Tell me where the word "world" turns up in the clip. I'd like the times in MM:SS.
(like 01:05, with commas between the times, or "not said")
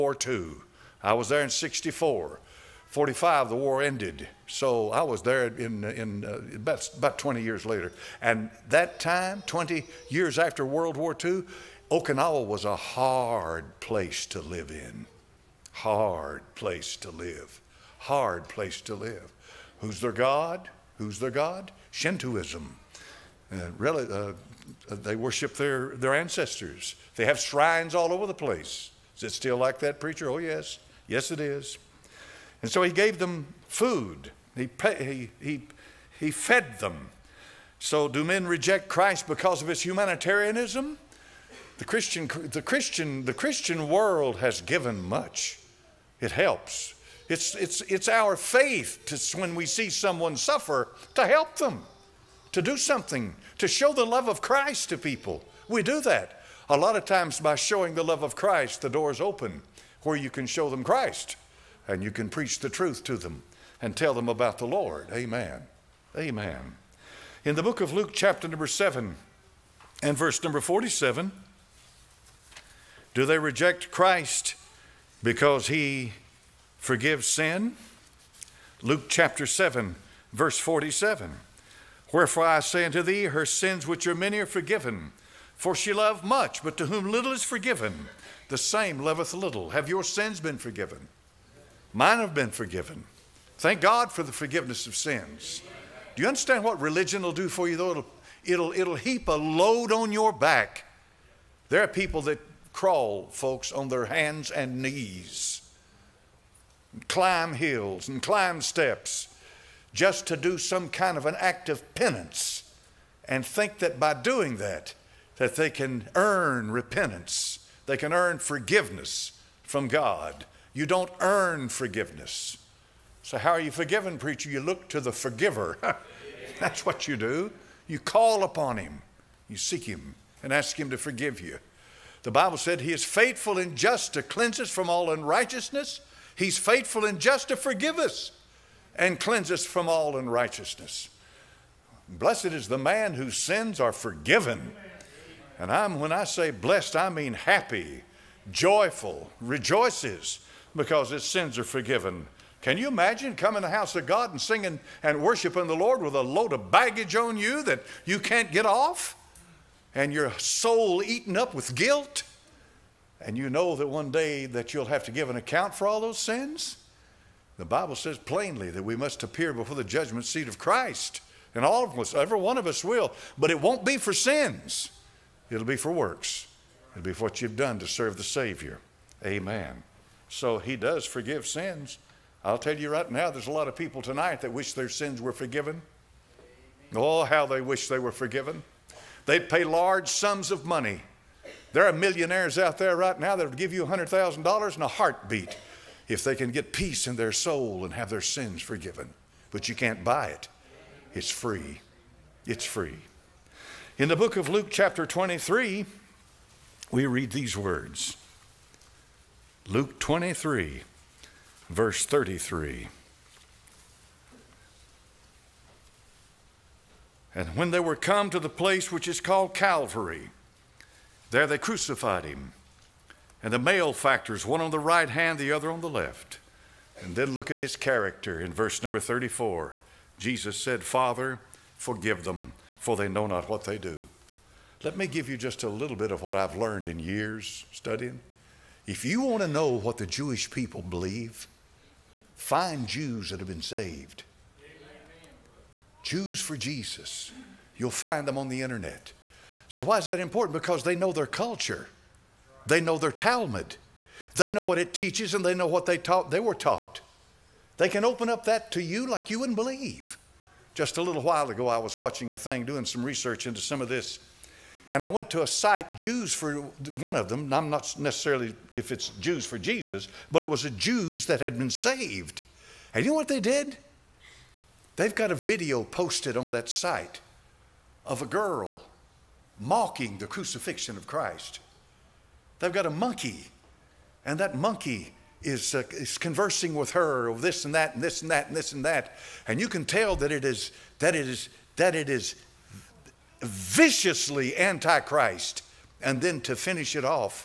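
00:10, 00:43.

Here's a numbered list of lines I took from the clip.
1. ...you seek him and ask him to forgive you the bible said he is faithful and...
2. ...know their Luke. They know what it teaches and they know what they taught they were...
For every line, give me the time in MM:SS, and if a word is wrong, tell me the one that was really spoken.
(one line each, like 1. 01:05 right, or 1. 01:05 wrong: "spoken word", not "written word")
1. 02:09 right
2. 04:12 wrong: "Talmud", not "Luke".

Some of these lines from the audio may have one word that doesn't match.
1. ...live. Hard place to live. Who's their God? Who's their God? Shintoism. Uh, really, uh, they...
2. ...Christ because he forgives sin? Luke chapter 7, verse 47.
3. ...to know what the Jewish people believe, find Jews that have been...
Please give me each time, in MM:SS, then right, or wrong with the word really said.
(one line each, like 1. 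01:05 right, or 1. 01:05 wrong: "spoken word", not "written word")
1. 00:17 right
2. 01:13 right
3. 03:59 right.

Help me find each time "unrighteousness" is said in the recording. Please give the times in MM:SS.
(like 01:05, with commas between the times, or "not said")
02:15, 02:20.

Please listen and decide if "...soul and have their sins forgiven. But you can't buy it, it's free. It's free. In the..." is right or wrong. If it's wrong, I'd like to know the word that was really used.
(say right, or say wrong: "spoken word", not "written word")
right.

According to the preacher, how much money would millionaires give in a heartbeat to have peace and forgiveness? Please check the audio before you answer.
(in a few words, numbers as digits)
$100,000.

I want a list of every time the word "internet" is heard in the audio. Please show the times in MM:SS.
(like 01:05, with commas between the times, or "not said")
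04:08.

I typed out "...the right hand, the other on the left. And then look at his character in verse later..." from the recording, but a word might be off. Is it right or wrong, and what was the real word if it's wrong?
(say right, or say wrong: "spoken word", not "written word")
wrong: "number", not "later".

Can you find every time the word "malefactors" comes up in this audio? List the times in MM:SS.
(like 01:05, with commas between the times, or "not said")
03:43.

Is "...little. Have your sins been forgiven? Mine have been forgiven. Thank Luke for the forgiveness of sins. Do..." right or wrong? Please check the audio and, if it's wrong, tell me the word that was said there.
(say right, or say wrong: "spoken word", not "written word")
wrong: "God", not "Luke".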